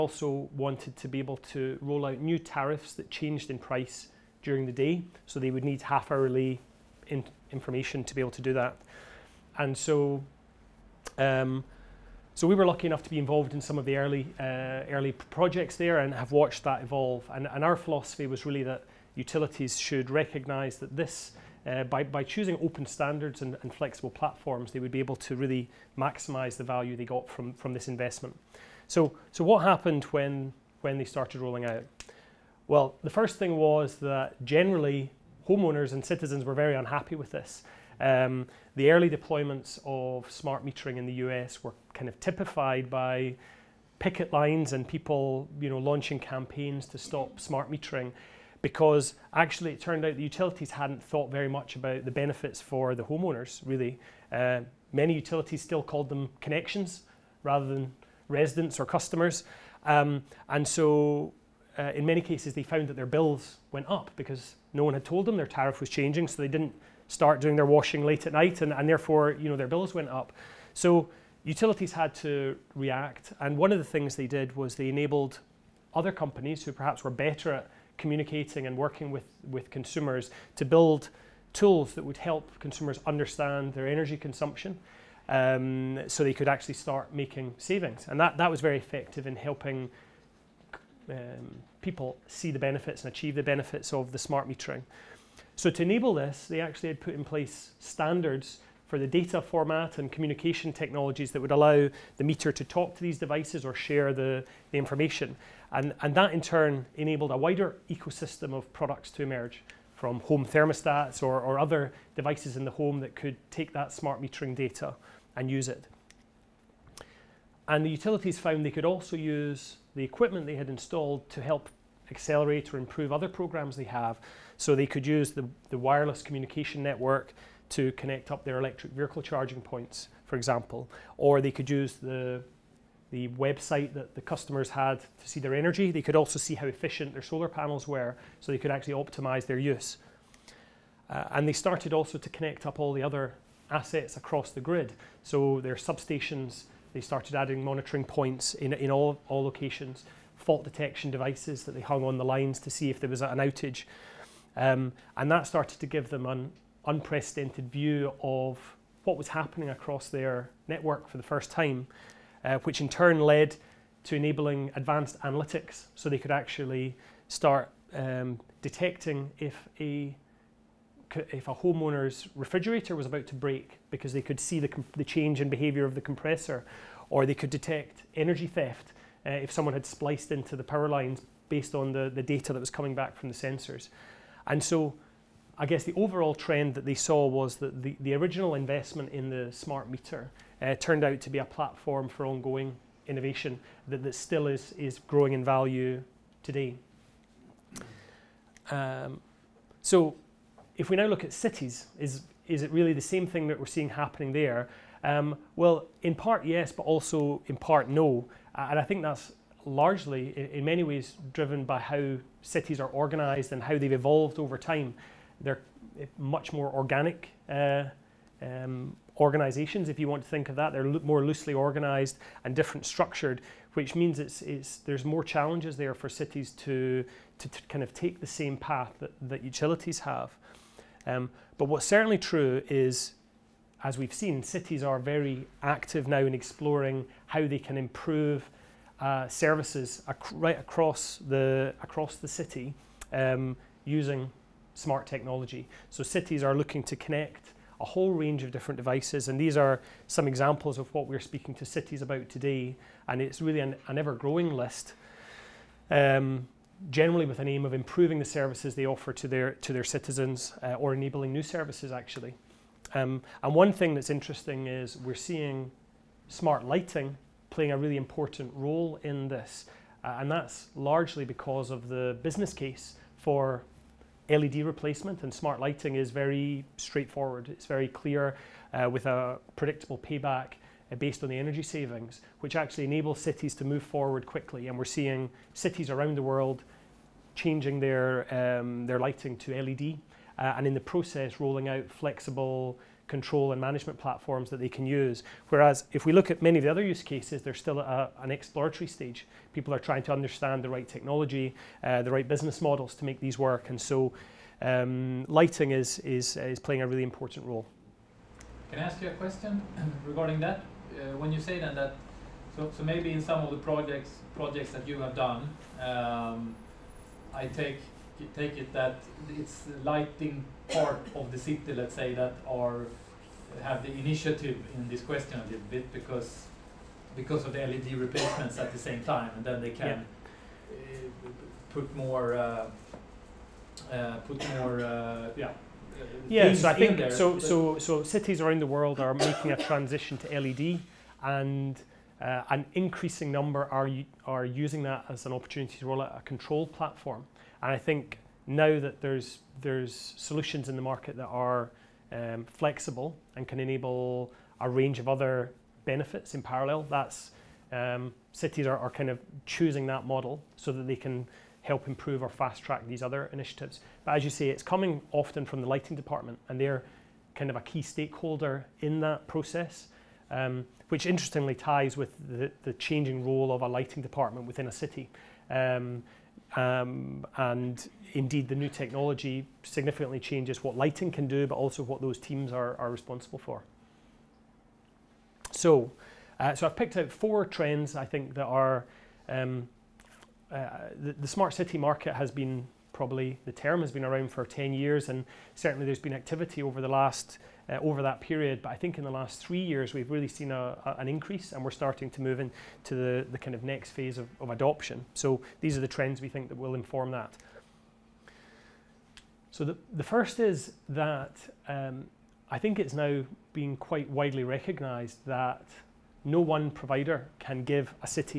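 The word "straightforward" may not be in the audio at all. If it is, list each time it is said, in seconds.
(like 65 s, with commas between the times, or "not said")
276 s.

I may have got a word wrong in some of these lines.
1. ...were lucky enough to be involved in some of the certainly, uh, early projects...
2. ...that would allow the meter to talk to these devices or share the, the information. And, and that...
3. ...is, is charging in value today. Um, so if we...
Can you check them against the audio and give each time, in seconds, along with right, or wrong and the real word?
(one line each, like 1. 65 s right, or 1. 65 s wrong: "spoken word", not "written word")
1. 12 s wrong: "early", not "certainly"
2. 101 s right
3. 194 s wrong: "growing", not "charging".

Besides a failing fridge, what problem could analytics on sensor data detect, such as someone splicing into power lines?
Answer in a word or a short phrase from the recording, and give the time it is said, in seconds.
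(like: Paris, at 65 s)
energy theft, at 178 s.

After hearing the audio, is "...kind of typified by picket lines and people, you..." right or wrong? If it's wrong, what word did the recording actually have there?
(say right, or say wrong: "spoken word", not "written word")
right.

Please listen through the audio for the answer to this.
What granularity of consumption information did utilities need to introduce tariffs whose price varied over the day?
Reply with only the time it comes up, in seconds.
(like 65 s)
5 s.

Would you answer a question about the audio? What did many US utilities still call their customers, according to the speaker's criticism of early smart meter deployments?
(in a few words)
connections.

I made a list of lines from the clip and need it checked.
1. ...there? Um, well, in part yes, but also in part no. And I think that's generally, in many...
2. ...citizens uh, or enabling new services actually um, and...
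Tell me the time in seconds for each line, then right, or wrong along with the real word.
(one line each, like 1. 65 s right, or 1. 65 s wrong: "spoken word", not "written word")
1. 204 s wrong: "largely", not "generally"
2. 259 s right.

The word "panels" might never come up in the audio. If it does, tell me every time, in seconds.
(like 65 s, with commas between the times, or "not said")
137 s.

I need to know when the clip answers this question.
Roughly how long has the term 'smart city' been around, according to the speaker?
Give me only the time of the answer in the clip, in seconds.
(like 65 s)
394 s.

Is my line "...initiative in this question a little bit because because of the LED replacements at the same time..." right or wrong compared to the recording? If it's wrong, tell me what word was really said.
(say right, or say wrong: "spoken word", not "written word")
right.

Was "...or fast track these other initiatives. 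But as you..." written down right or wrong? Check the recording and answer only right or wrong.
right.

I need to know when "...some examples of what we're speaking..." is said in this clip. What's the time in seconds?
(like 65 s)
250 s.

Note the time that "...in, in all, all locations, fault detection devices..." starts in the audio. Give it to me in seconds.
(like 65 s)
148 s.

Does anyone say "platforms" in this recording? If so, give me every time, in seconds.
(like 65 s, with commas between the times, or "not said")
24 s, 191 s, 293 s, 346 s.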